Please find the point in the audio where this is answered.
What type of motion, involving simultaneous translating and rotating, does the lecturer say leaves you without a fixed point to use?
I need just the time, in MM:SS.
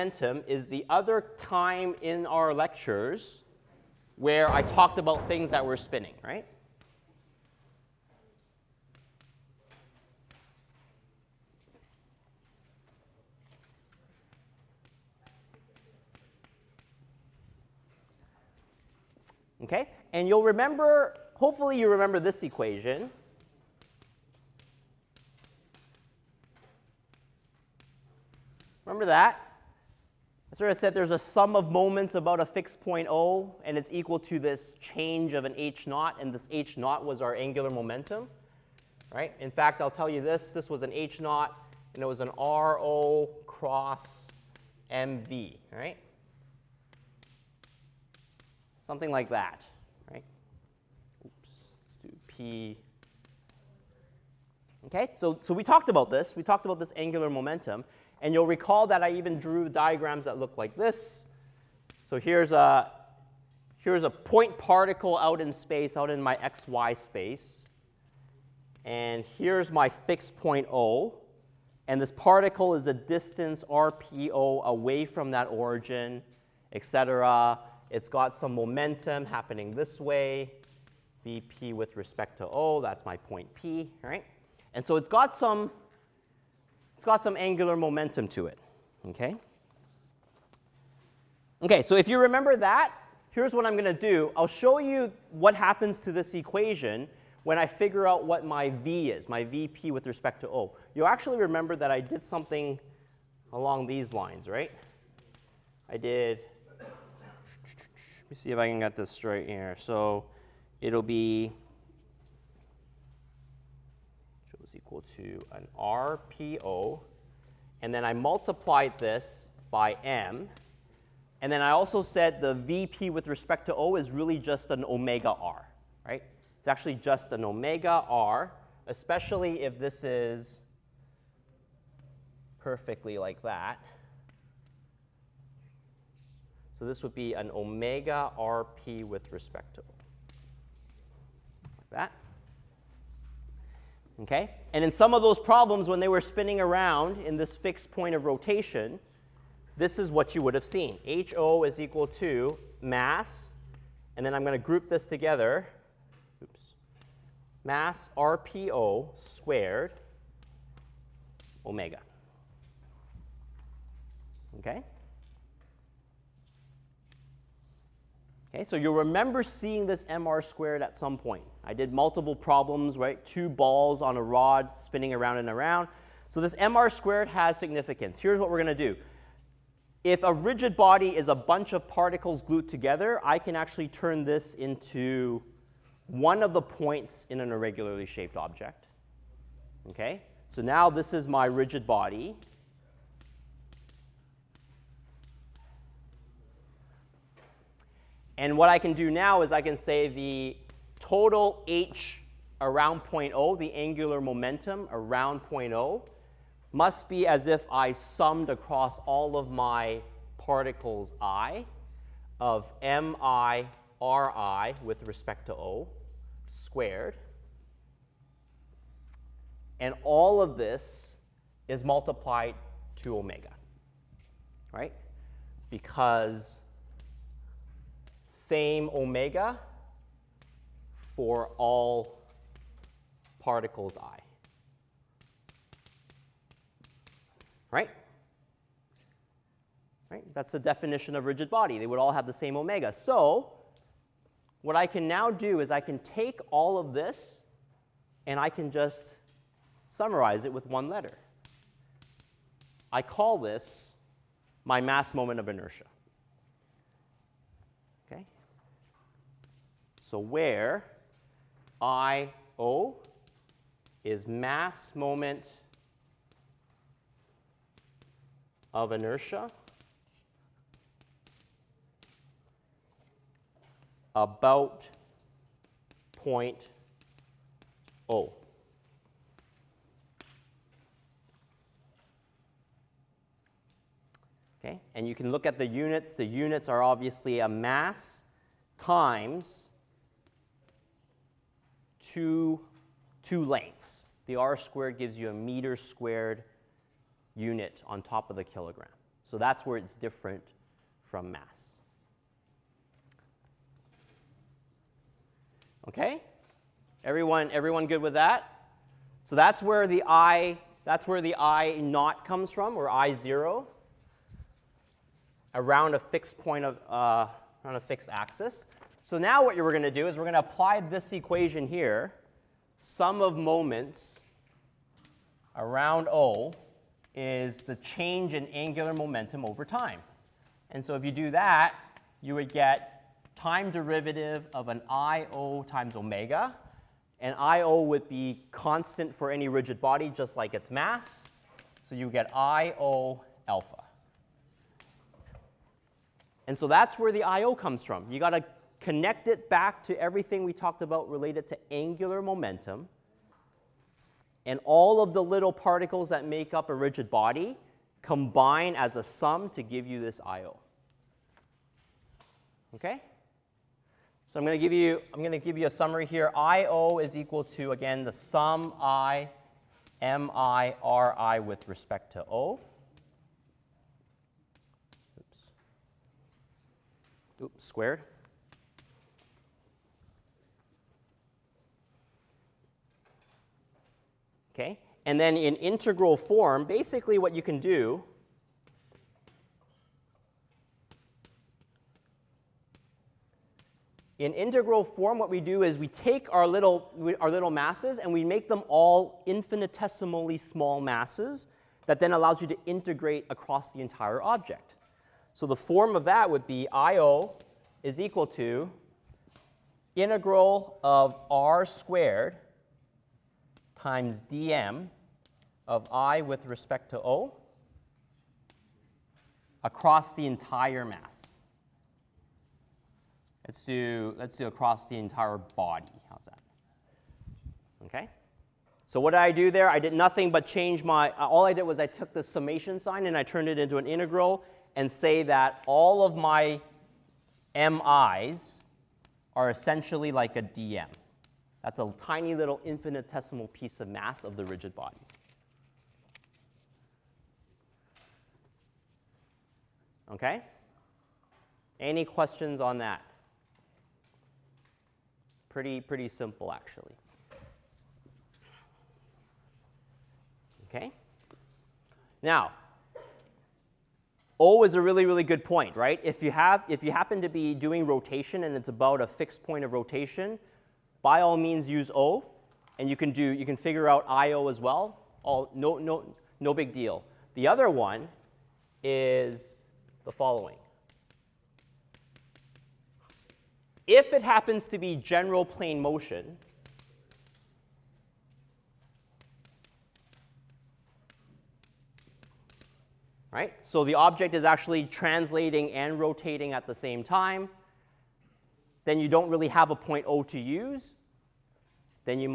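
08:04.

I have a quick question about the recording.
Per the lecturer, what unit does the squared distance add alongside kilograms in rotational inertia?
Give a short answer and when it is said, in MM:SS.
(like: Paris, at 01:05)
meter squared, at 04:55.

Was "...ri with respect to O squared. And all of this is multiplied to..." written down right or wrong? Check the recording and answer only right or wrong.
right.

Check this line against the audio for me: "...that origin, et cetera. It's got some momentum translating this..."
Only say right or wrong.
wrong.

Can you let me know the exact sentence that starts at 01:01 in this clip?
So here's a, here's a point particle out in space, out in my xy space.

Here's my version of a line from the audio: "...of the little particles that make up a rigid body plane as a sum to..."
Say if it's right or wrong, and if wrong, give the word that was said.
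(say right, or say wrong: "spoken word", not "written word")
wrong: "combine", not "plane".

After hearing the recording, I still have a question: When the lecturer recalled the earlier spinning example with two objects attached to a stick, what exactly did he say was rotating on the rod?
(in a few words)
Two balls.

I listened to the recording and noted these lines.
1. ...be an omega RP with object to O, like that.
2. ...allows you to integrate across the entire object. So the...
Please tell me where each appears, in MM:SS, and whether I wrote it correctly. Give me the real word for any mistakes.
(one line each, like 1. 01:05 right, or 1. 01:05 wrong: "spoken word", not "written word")
1. 02:17 wrong: "respect", not "object"
2. 06:42 right.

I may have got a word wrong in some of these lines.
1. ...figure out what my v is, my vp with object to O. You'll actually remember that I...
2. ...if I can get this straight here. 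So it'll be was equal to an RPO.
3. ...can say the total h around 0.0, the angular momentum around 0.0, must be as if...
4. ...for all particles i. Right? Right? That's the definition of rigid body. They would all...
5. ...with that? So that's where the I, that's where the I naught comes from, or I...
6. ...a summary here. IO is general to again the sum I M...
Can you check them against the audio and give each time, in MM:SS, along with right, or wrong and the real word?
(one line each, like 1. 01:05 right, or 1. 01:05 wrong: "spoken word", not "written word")
1. 01:37 wrong: "respect", not "object"
2. 01:48 right
3. 03:19 right
4. 03:51 right
5. 05:08 right
6. 06:05 wrong: "equal", not "general".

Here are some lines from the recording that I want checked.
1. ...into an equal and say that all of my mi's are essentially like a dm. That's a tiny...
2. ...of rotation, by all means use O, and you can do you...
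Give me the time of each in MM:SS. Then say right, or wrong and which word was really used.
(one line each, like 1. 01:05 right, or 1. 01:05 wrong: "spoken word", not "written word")
1. 07:13 wrong: "integral", not "equal"
2. 07:49 right.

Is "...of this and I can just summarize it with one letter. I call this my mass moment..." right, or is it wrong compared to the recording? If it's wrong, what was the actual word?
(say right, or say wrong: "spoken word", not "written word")
right.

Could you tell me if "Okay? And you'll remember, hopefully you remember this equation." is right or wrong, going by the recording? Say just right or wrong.
right.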